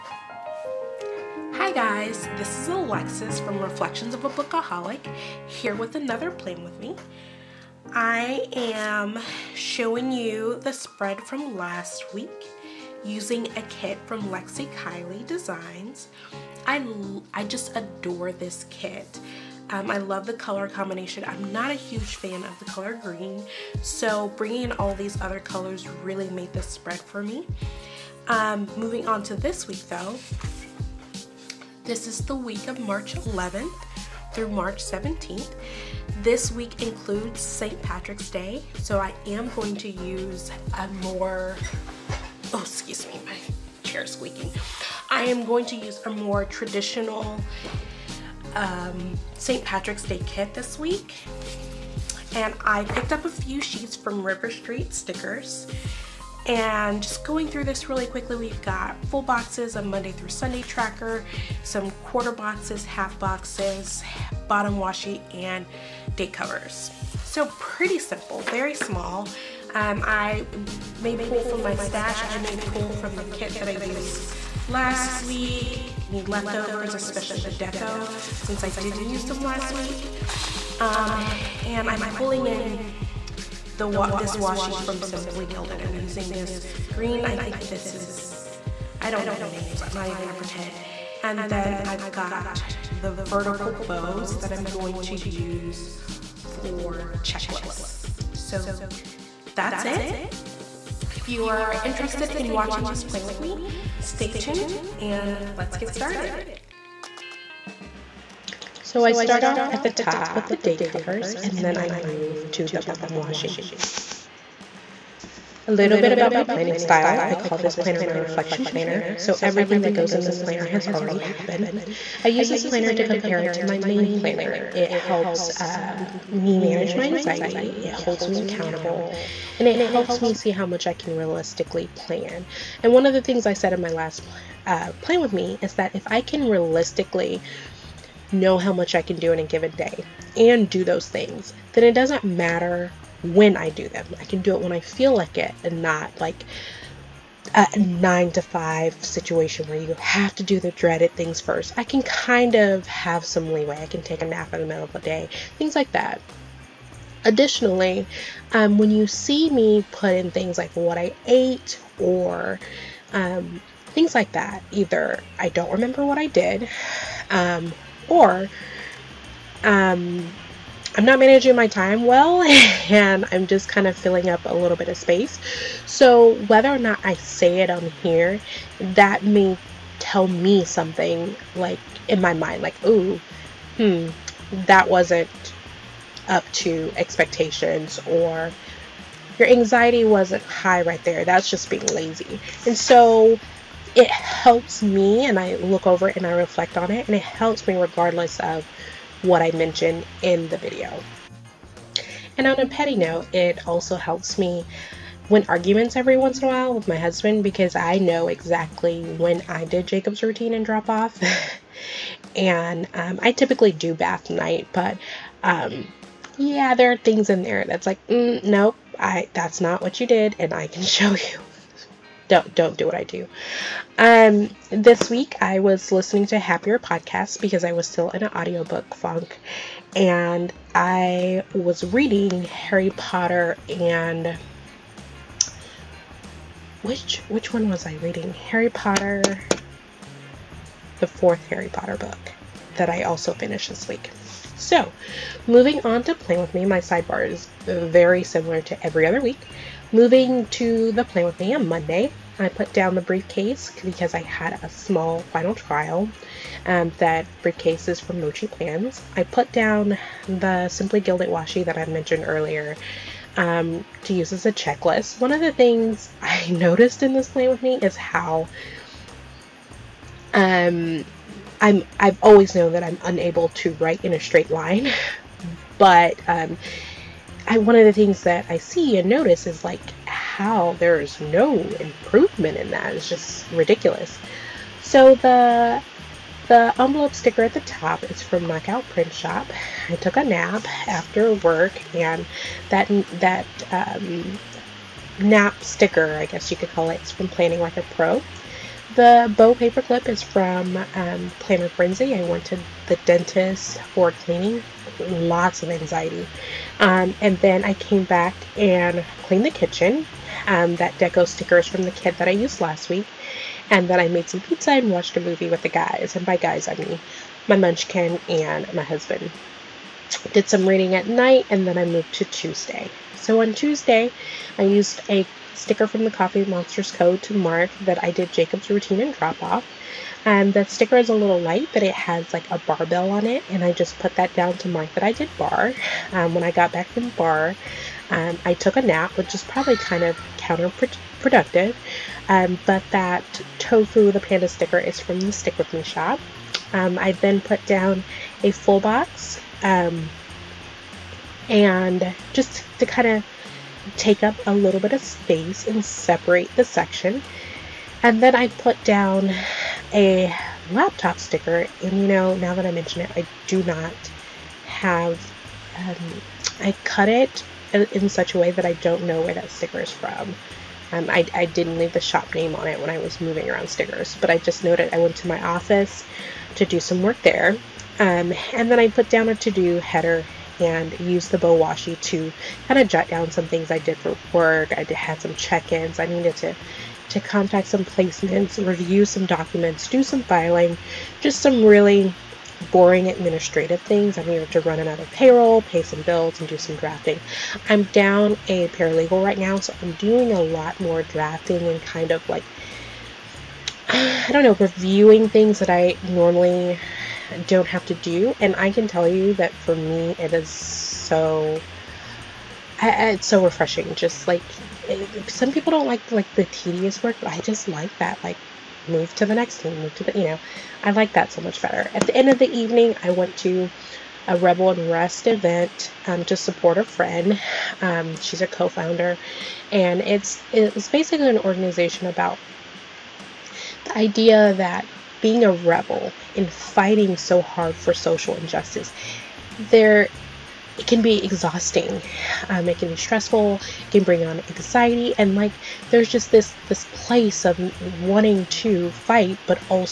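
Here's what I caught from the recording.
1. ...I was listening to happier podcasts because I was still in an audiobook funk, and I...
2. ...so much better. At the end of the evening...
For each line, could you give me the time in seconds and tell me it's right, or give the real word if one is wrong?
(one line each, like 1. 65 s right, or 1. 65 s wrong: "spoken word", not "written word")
1. 225 s right
2. 421 s right.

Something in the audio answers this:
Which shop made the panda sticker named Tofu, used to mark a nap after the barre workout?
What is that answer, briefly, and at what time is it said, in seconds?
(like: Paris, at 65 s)
Stick With Me, at 345 s.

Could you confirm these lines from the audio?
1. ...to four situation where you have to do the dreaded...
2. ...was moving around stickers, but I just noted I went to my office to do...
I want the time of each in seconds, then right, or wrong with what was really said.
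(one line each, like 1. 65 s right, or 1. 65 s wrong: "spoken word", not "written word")
1. 148 s wrong: "five", not "four"
2. 372 s right.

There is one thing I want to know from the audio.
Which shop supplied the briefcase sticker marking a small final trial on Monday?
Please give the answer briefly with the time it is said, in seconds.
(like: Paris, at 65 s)
Mochi Plans, at 258 s.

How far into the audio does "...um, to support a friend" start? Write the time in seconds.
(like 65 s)
426 s.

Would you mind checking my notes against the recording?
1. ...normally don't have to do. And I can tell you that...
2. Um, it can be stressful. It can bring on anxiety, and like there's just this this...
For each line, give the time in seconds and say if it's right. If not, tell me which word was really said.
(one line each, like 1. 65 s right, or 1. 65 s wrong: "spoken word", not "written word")
1. 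406 s right
2. 442 s right.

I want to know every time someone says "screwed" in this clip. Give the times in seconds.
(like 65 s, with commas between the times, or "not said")
not said.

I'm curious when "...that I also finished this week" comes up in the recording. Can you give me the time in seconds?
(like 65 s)
242 s.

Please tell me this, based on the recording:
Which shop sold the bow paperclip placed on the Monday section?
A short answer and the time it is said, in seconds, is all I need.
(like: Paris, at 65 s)
Planner Frenzy, at 301 s.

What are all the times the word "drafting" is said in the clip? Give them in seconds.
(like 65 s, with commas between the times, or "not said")
396 s, 401 s.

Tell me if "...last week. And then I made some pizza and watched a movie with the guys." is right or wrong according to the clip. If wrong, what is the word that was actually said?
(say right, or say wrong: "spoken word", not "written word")
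right.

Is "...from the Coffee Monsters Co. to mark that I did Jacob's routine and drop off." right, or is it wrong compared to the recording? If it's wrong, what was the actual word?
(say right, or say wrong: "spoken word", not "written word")
right.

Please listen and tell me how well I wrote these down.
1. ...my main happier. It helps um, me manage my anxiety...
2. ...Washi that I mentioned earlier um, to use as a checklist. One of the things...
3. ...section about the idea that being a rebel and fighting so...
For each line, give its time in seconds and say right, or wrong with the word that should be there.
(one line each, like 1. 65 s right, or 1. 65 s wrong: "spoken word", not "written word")
1. 123 s wrong: "planner", not "happier"
2. 261 s right
3. 431 s wrong: "organization", not "section".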